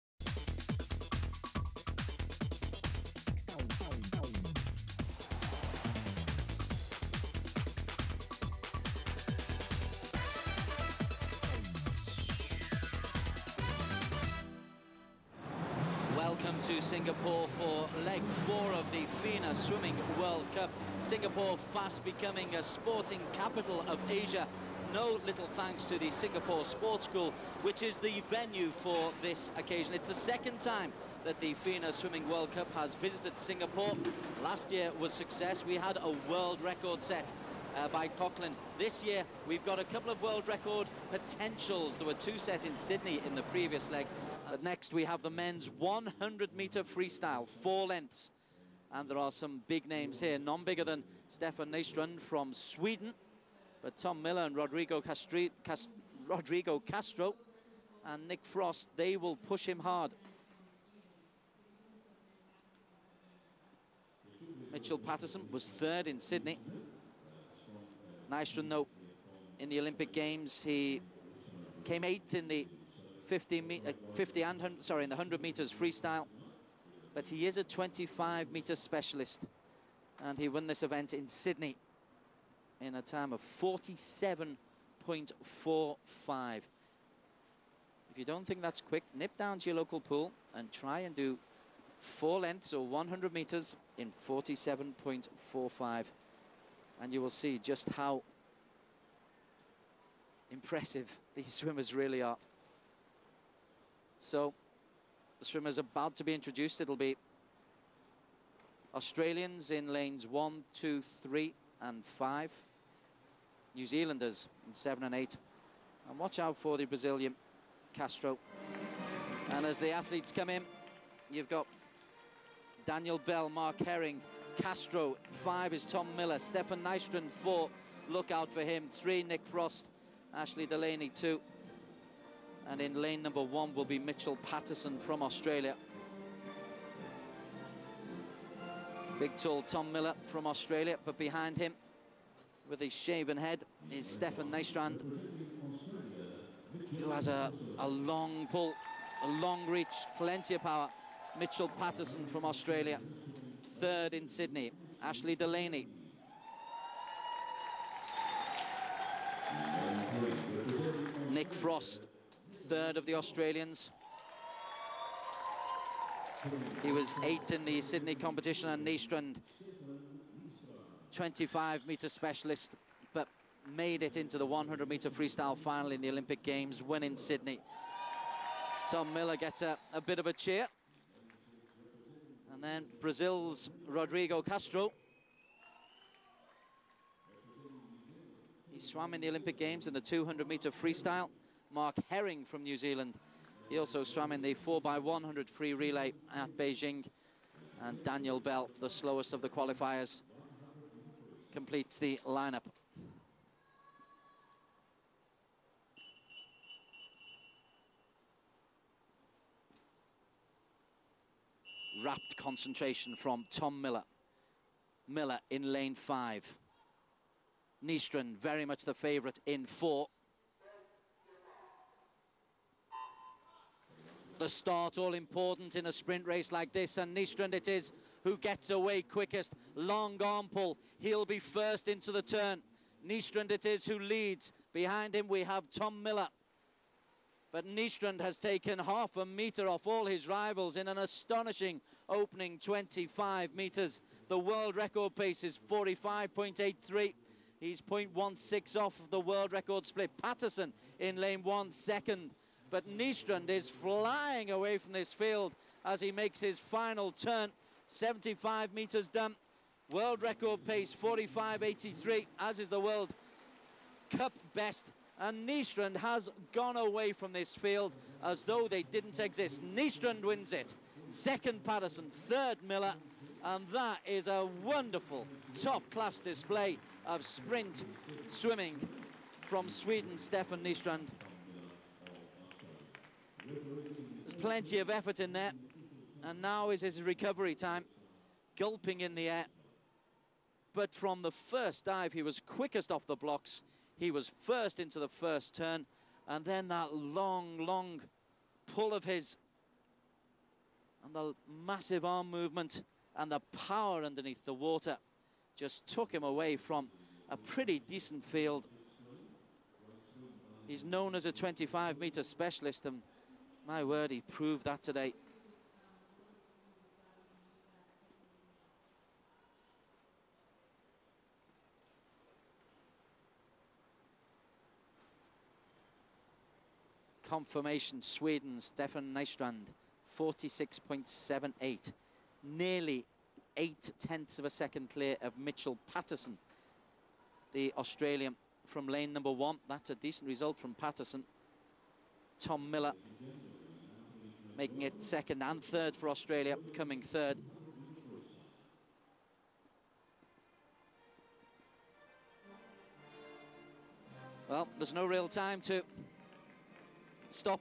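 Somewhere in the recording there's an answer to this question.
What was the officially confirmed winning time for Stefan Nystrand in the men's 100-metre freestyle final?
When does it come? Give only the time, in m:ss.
5:30.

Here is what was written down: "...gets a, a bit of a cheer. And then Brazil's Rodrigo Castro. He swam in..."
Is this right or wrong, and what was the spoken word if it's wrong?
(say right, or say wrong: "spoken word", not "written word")
right.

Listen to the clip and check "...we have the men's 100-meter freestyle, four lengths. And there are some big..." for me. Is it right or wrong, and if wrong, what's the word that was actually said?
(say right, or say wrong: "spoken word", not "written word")
right.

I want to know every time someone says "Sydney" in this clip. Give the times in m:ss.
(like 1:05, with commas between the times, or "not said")
0:42, 1:06, 1:21, 2:34, 2:47, 2:57.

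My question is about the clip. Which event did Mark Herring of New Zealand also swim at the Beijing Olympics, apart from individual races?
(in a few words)
4x100 free relay.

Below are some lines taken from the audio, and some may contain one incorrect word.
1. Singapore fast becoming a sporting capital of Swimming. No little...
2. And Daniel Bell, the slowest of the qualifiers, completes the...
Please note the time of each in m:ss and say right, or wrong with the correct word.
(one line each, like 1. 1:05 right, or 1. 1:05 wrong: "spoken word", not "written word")
1. 0:21 wrong: "Asia", not "Swimming"
2. 3:17 right.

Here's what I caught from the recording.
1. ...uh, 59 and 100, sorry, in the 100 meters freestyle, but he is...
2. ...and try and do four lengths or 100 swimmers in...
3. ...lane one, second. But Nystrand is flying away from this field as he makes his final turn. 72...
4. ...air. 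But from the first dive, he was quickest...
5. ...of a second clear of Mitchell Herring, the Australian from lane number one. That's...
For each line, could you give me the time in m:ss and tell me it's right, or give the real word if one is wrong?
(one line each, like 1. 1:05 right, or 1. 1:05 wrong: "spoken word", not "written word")
1. 1:13 wrong: "50", not "59"
2. 1:30 wrong: "meters", not "swimmers"
3. 4:11 wrong: "75", not "72"
4. 4:49 right
5. 5:34 wrong: "Patterson", not "Herring".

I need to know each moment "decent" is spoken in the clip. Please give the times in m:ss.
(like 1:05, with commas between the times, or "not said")
5:07, 5:39.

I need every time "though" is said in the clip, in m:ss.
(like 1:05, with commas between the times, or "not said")
1:08, 4:28.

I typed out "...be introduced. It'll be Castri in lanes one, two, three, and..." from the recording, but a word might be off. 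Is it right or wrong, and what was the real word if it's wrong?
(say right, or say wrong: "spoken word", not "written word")
wrong: "Australians", not "Castri".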